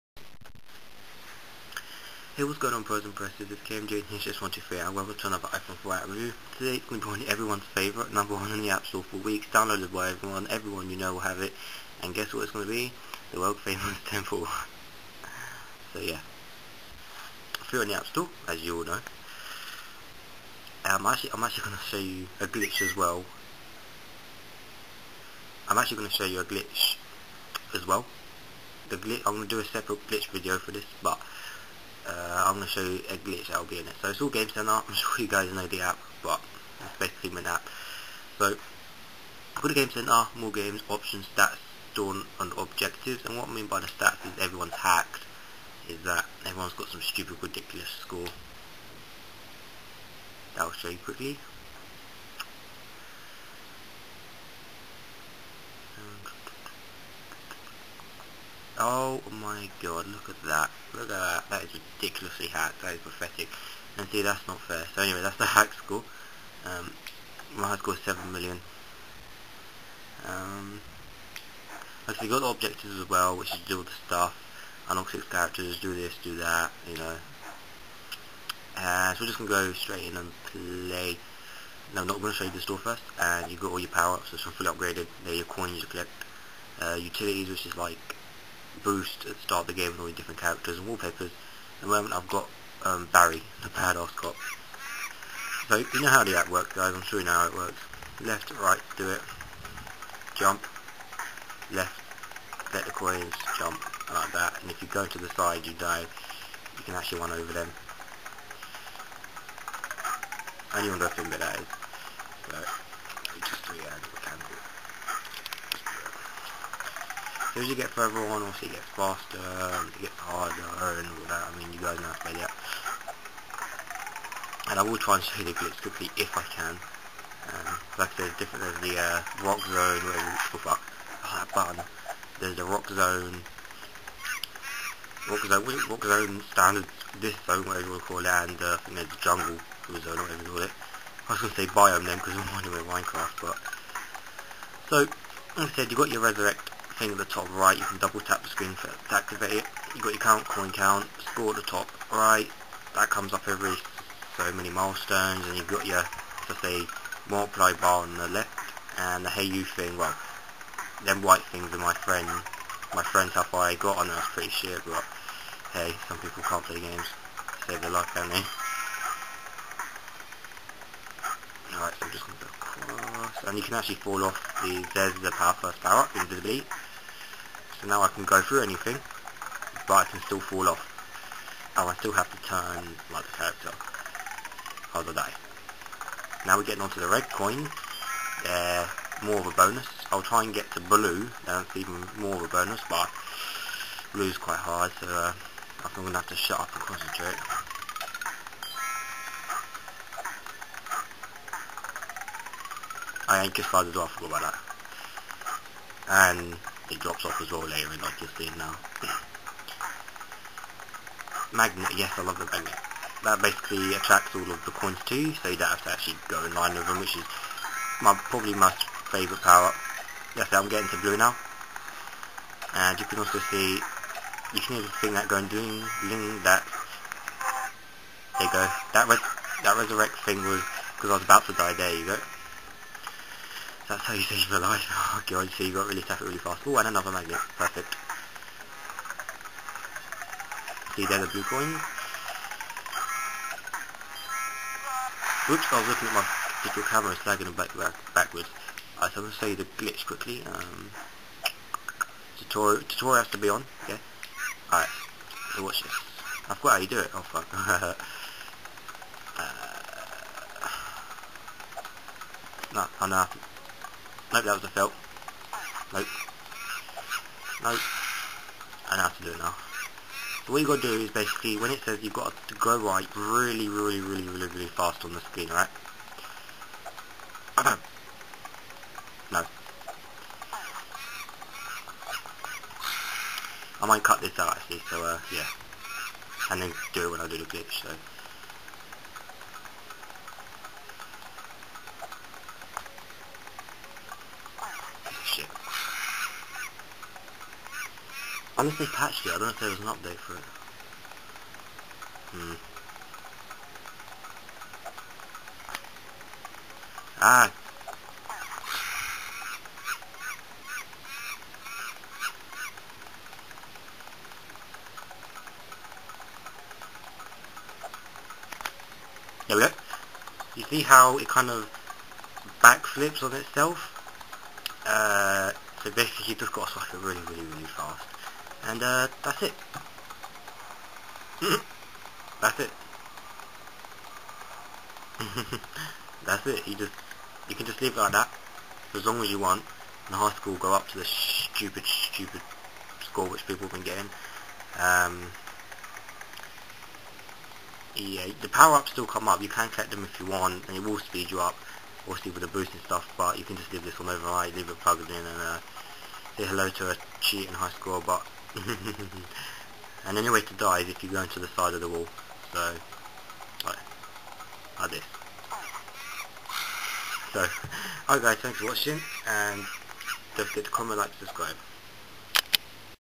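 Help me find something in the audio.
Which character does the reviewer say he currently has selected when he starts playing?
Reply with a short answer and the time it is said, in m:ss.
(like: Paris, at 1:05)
Barry, at 1:33.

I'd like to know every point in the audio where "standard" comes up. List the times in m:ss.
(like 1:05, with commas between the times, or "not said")
2:16.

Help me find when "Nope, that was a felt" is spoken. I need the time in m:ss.
4:24.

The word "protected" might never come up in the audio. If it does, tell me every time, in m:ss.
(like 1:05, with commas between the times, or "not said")
not said.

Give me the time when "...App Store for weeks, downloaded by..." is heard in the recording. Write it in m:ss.
0:08.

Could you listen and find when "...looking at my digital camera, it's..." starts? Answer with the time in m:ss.
4:05.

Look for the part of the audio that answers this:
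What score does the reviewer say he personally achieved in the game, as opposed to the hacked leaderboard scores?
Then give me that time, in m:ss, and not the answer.
1:07.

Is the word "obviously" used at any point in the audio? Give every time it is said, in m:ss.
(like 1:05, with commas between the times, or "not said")
1:58, 5:52.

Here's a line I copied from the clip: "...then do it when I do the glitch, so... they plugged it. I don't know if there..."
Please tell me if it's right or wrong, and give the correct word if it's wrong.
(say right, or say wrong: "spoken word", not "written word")
wrong: "patched", not "plugged".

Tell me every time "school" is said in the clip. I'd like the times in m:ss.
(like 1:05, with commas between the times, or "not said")
5:40, 5:57.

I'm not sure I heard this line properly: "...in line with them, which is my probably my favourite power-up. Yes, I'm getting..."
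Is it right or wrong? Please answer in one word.
right.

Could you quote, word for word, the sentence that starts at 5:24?
Uh, so basically you just got to swap it really, really, really fast.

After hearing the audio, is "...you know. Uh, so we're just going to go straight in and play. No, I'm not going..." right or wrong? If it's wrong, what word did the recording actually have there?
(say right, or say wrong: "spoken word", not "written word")
right.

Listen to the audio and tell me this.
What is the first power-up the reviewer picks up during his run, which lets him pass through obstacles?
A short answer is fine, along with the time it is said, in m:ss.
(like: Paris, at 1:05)
invisibility, at 2:56.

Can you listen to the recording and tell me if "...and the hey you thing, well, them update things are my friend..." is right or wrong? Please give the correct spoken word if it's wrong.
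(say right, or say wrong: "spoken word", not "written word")
wrong: "white", not "update".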